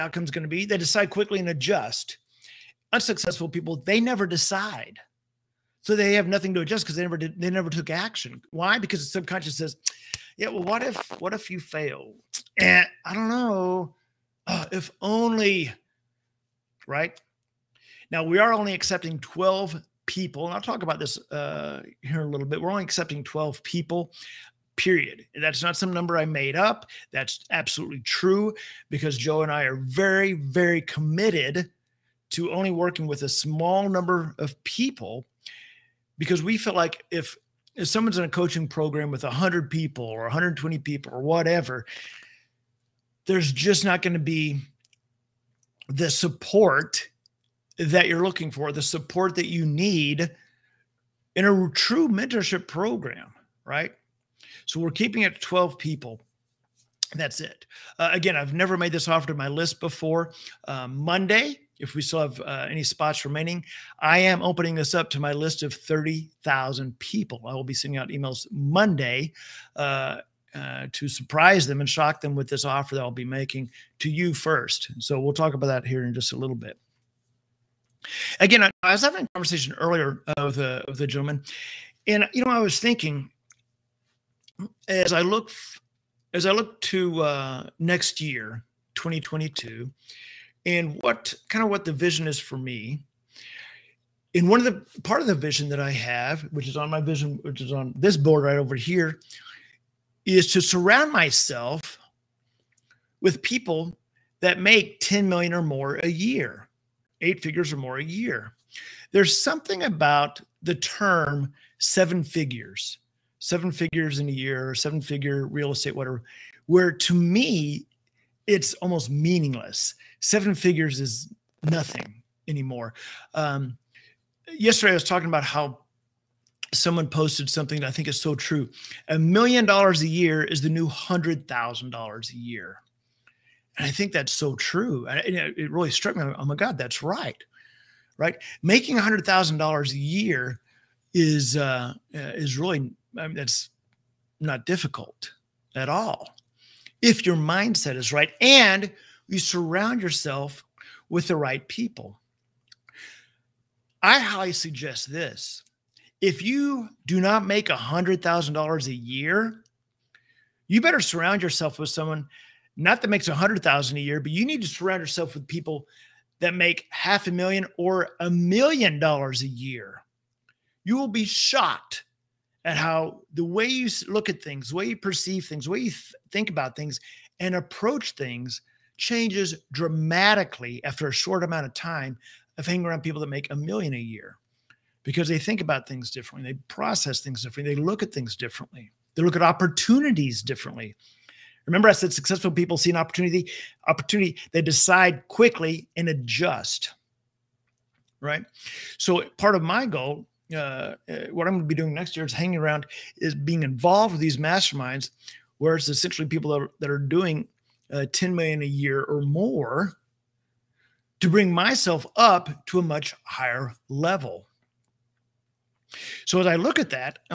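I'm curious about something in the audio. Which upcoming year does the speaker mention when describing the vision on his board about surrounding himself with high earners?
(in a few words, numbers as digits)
2022.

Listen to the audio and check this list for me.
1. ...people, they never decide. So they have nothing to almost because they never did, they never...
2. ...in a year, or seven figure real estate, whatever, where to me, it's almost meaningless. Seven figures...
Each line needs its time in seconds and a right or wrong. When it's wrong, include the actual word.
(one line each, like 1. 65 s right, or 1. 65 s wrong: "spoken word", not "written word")
1. 3 s wrong: "adjust", not "almost"
2. 114 s right.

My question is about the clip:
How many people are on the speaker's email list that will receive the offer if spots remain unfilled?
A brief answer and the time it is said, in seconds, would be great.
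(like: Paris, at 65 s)
30,000, at 65 s.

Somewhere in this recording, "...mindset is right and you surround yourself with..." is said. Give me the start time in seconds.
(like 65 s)
147 s.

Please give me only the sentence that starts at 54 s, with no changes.
So we're keeping it 12 people.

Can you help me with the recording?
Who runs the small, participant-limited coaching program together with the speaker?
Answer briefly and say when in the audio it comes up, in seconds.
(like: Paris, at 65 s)
Joe, at 29 s.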